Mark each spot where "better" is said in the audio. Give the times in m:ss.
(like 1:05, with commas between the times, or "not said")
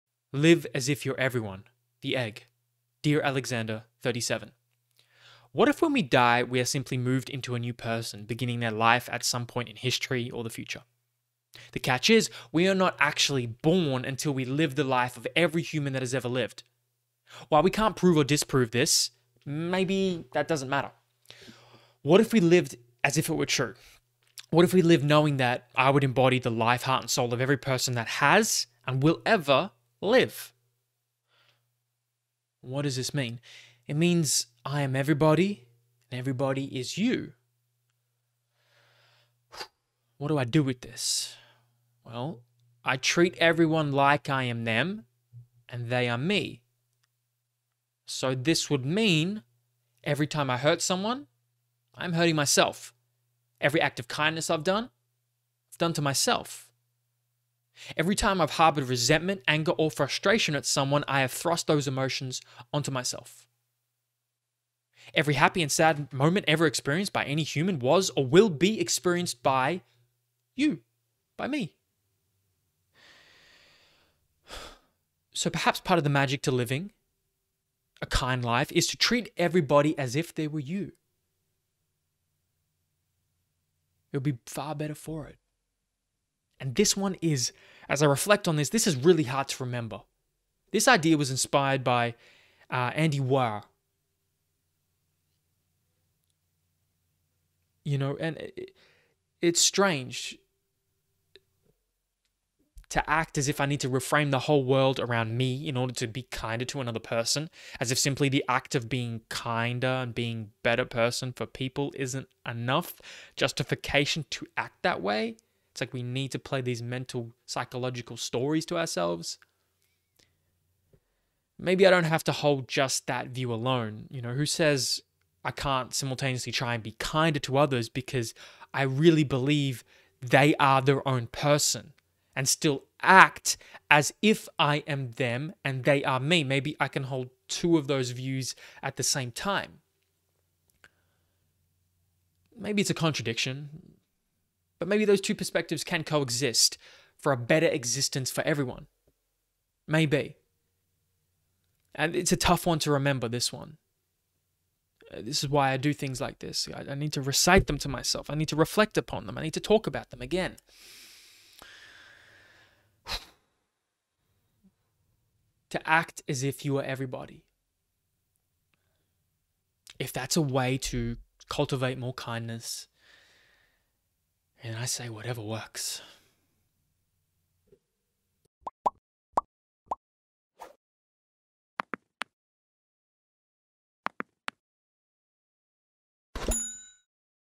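1:24, 1:50, 2:27.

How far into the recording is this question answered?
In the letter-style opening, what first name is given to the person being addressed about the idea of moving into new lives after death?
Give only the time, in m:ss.
0:03.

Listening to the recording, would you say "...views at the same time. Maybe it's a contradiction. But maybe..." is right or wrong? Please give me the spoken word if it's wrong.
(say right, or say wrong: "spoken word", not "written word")
right.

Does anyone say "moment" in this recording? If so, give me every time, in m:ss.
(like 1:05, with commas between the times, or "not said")
1:06.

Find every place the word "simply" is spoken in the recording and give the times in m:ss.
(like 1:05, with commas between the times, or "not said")
0:06, 1:47.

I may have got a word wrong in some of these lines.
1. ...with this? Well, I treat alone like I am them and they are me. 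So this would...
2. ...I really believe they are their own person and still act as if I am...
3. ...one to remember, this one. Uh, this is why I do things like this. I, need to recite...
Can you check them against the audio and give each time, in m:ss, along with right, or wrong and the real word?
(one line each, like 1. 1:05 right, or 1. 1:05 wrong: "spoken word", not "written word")
1. 0:40 wrong: "everyone", not "alone"
2. 2:08 right
3. 2:32 right.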